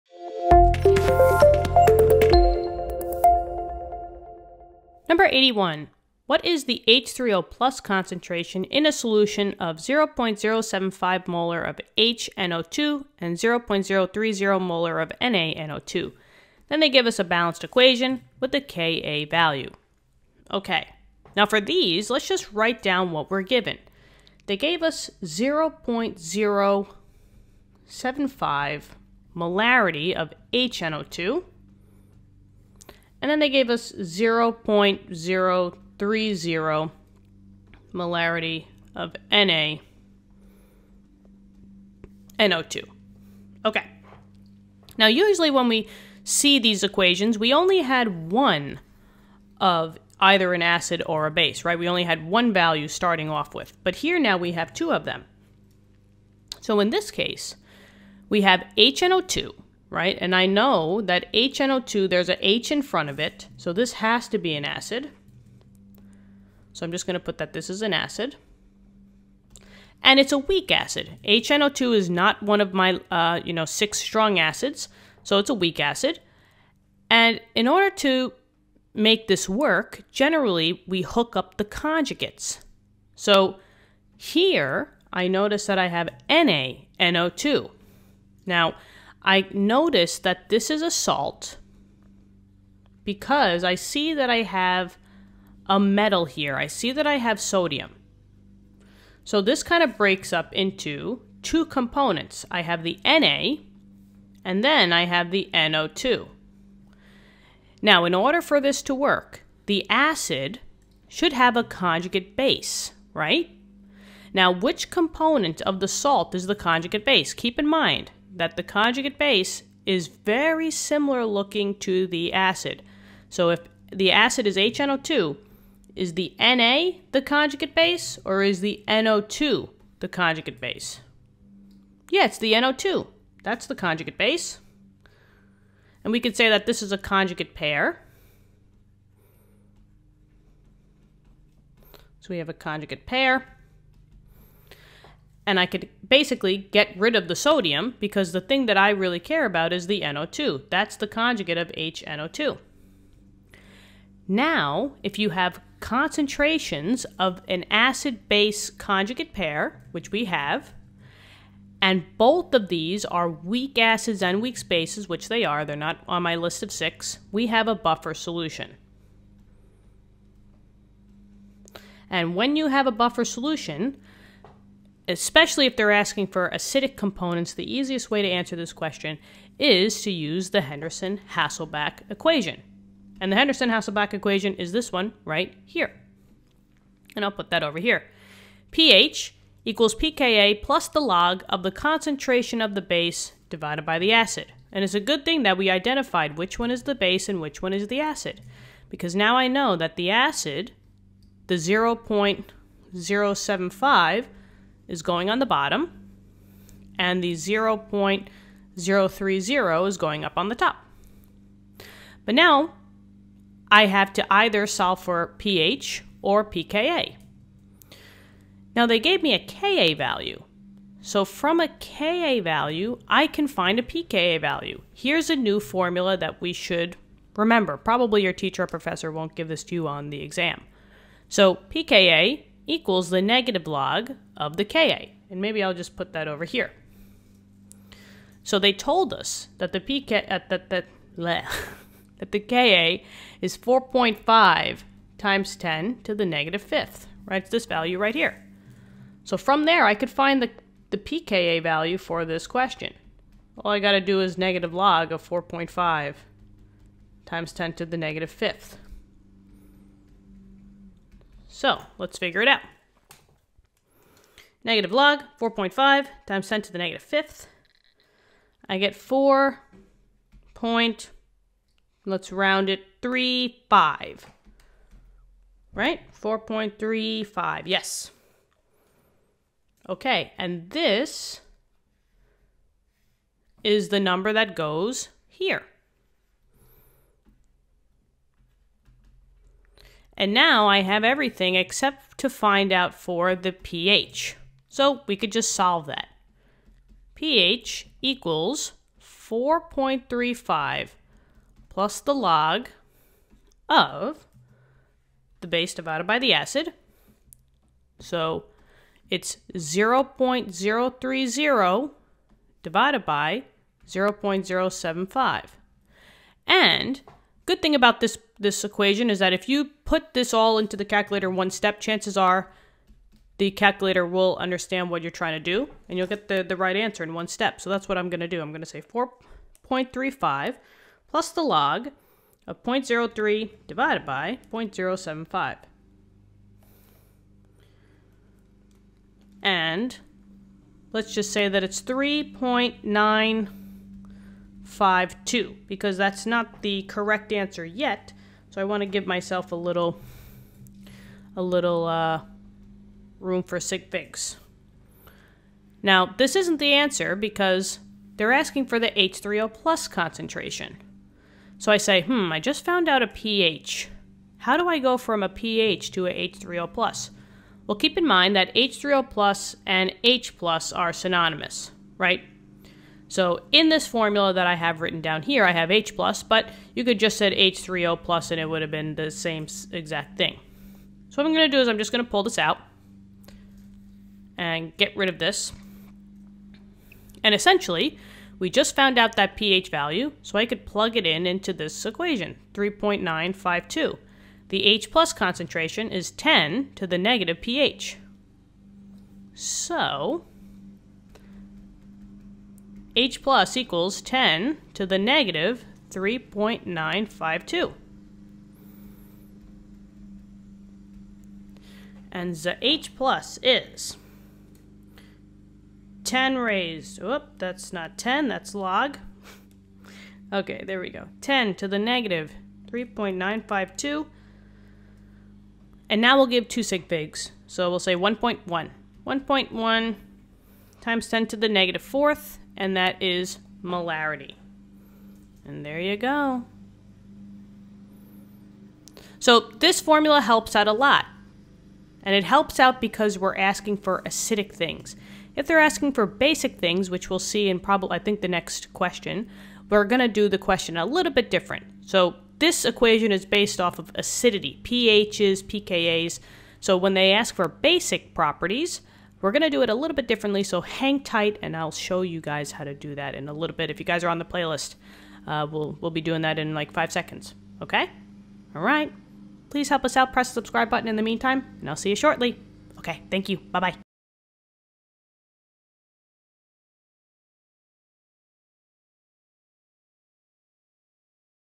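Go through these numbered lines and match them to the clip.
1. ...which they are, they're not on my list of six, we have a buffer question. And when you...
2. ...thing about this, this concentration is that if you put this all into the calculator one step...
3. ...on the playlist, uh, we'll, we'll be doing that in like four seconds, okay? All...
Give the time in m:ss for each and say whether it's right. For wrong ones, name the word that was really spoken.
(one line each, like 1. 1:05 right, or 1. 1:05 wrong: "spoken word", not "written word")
1. 2:45 wrong: "solution", not "question"
2. 5:17 wrong: "equation", not "concentration"
3. 7:44 wrong: "five", not "four".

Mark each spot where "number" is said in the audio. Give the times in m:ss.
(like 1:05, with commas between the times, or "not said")
0:05, 4:43.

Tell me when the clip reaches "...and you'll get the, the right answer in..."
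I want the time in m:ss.
5:25.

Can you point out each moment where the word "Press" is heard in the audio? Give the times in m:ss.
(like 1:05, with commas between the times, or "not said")
7:50.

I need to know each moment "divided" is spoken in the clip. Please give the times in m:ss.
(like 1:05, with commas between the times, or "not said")
3:13, 5:05, 5:12, 5:33.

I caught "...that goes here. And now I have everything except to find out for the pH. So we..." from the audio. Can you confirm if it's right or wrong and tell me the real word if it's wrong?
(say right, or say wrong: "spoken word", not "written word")
right.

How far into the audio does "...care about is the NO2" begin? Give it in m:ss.
2:29.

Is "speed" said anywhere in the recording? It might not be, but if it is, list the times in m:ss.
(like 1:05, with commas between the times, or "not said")
not said.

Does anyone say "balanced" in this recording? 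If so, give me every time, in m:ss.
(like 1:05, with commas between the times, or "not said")
0:17.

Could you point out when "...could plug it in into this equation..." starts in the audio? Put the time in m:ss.
6:30.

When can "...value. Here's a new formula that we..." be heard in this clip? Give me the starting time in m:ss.
3:44.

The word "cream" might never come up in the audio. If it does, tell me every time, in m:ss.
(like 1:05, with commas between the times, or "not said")
not said.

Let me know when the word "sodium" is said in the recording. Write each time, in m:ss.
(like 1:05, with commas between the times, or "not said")
1:37, 2:27.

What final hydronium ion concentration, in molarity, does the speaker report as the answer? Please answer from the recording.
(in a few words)
1.1 x 10^-4.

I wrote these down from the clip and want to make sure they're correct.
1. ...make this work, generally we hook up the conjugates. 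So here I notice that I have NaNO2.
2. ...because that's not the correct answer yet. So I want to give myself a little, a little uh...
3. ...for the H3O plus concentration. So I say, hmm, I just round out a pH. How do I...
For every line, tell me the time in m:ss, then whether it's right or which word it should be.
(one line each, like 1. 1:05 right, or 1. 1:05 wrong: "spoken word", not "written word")
1. 1:18 right
2. 5:45 right
3. 5:58 wrong: "found", not "round".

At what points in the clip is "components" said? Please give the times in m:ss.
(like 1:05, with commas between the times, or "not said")
1:41, 1:54, 2:56.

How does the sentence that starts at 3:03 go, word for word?
And the Henderson-Hasselbalch equation is this one right here.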